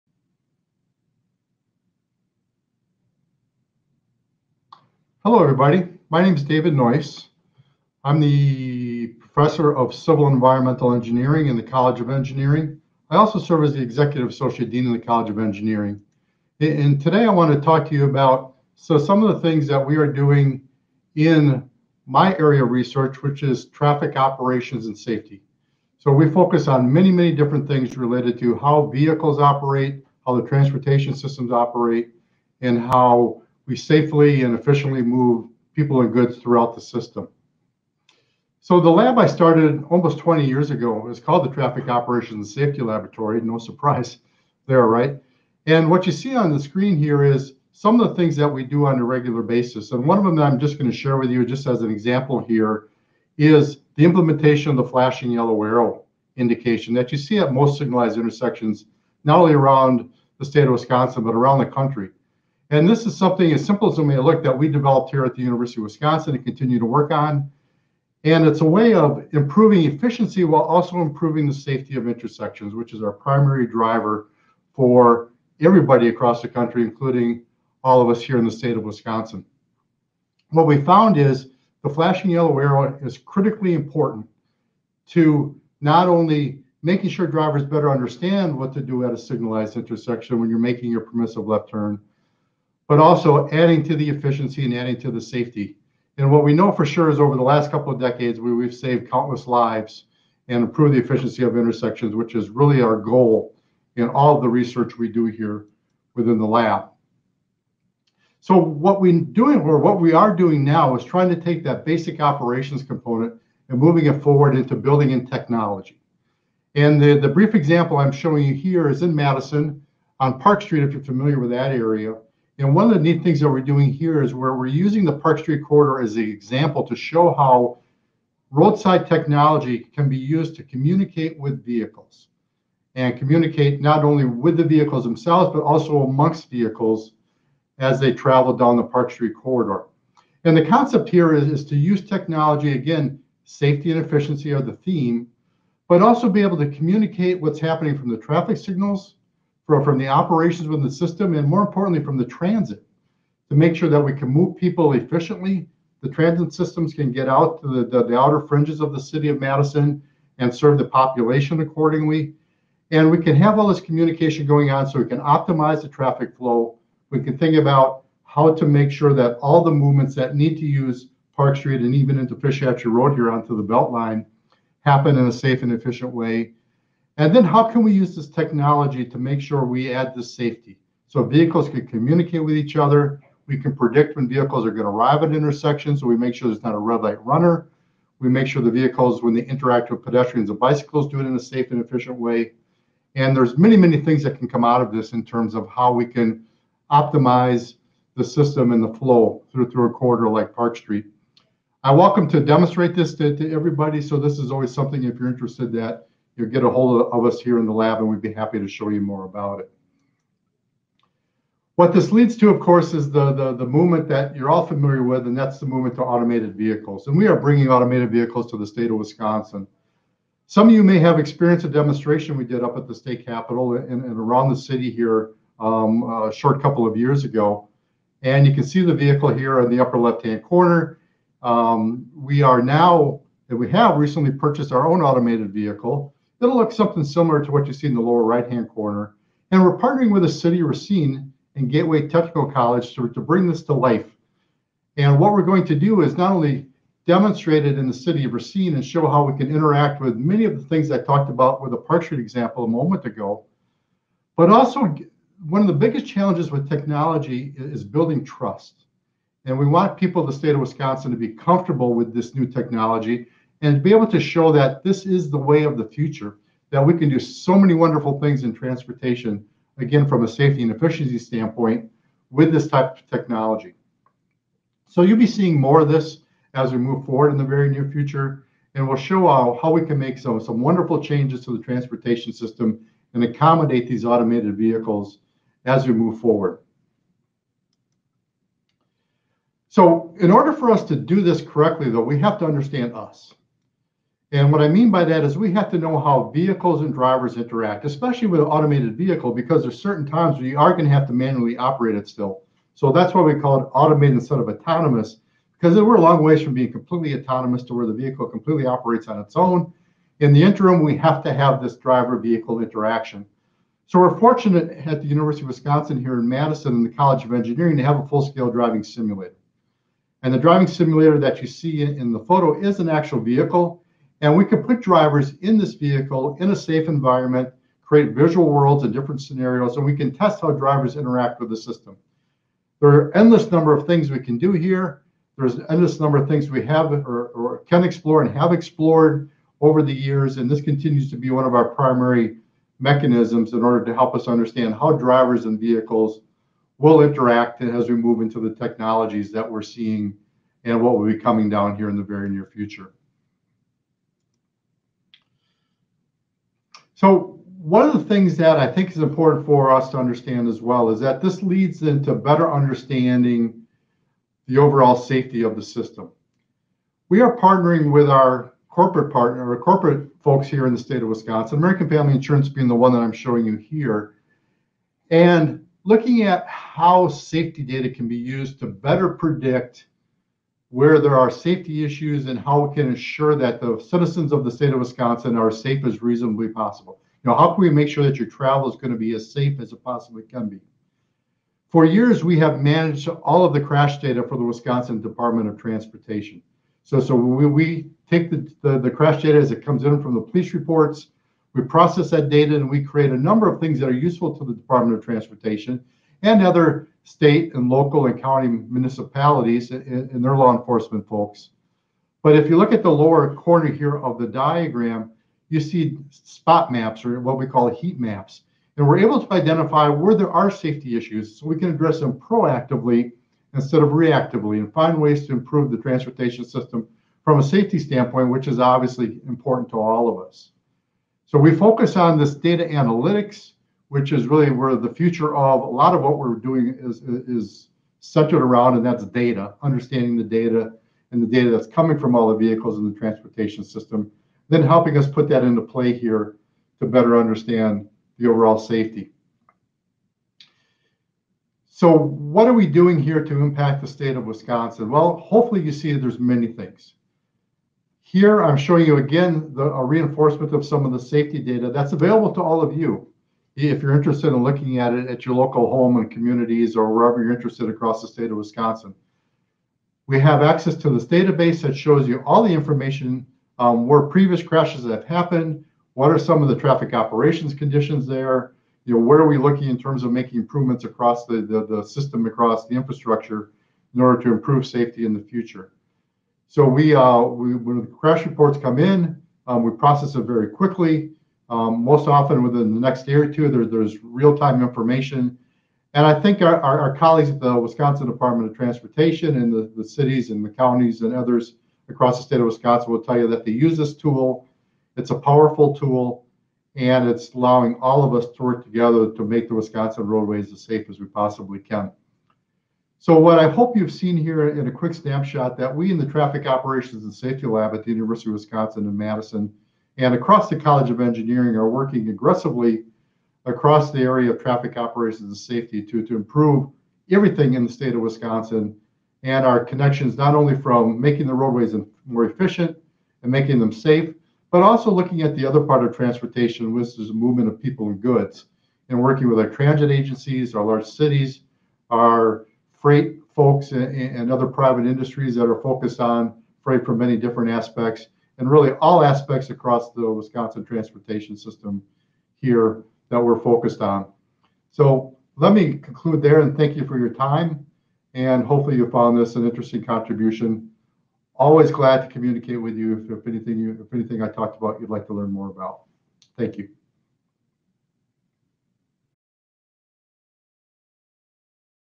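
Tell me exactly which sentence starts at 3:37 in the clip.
And we are bringing automated vehicles to the state of Wisconsin.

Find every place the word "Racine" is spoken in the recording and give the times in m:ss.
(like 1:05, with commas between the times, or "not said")
4:00, 4:08.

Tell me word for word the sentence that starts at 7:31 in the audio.
So what are we doing here to impact the state of Wisconsin?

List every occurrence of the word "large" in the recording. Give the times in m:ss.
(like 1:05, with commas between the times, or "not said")
9:00.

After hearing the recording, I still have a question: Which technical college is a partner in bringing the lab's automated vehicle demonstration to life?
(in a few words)
Gateway Technical College.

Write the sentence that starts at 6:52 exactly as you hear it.
But if you look at the lower corner here of the diagram, you see spot maps or what we call heat maps.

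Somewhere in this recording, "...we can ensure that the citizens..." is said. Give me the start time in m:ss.
6:22.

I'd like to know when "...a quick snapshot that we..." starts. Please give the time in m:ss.
8:34.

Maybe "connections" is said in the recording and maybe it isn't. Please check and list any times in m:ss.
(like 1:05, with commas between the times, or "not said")
8:49.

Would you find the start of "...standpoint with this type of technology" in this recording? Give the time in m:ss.
4:31.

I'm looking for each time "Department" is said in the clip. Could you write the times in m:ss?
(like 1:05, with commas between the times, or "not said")
6:35, 6:44, 8:18.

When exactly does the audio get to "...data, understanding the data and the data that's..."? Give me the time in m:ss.
7:19.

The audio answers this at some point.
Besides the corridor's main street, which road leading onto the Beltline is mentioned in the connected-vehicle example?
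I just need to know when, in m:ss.
2:52.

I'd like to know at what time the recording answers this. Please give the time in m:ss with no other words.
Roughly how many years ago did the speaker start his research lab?
0:39.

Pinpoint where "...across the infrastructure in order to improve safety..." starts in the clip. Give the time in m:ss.
8:02.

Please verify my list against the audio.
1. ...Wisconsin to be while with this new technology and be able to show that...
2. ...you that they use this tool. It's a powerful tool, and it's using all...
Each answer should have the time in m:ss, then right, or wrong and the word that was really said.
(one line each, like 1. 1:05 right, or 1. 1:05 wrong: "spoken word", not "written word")
1. 4:20 wrong: "comfortable", not "while"
2. 8:23 wrong: "allowing", not "using".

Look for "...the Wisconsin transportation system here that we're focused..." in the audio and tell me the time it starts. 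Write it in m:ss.
9:09.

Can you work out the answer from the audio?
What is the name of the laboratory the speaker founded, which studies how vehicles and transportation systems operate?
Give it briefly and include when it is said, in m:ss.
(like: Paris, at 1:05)
Traffic Operations Safety Laboratory, at 0:41.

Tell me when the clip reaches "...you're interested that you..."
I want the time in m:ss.
3:25.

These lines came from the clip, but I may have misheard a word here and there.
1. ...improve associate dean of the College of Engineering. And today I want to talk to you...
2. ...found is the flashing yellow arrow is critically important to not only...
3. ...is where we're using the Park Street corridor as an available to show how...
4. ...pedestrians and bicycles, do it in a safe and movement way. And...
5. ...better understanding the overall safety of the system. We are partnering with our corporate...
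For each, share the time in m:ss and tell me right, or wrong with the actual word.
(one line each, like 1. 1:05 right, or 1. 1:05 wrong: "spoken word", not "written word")
1. 0:13 wrong: "executive", not "improve"
2. 1:20 right
3. 2:04 wrong: "example", not "available"
4. 3:10 wrong: "efficient", not "movement"
5. 6:02 right.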